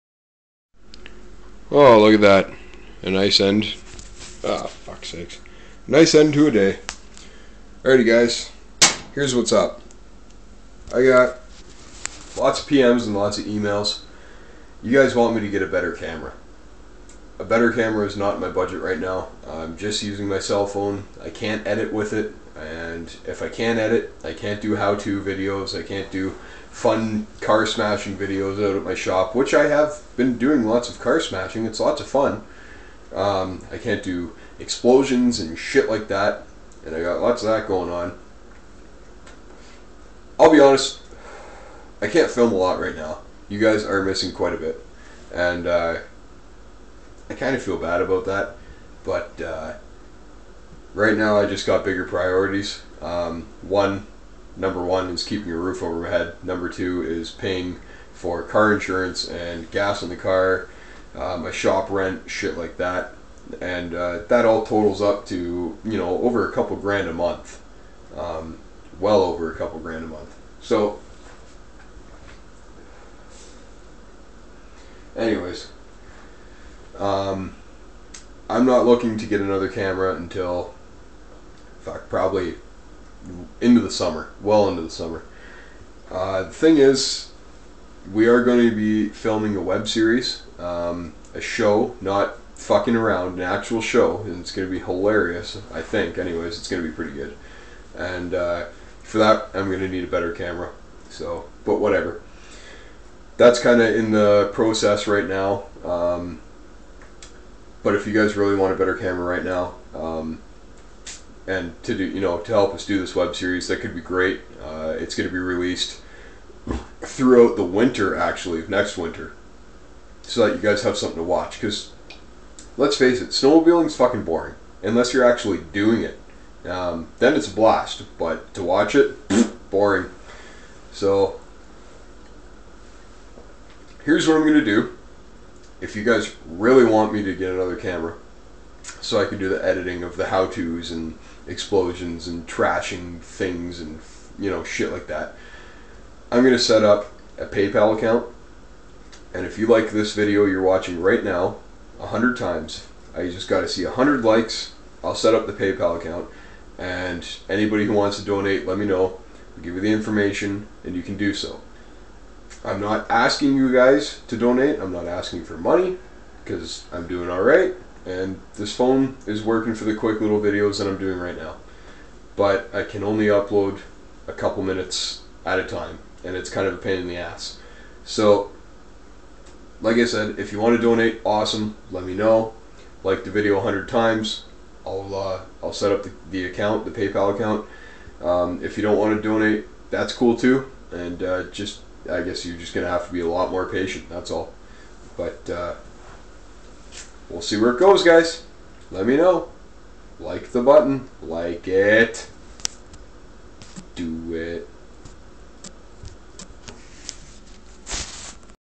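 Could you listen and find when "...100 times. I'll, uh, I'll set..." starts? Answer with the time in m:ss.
3:03.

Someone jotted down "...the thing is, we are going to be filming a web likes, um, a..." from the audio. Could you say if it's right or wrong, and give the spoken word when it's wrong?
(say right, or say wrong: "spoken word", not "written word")
wrong: "series", not "likes".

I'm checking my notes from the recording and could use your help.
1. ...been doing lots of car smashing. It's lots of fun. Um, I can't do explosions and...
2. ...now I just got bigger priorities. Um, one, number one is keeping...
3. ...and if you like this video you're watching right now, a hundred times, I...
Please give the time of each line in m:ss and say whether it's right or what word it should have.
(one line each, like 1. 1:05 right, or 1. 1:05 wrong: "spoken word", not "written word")
1. 0:30 right
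2. 0:51 right
3. 2:29 right.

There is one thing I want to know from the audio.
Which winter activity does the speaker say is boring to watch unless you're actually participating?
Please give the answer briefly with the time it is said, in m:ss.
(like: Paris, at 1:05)
snowmobiling, at 2:03.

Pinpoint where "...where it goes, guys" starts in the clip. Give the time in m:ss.
3:17.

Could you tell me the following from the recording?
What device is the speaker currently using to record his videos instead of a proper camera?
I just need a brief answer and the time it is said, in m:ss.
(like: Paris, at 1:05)
cell phone, at 0:20.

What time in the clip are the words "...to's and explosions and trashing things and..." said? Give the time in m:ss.
2:20.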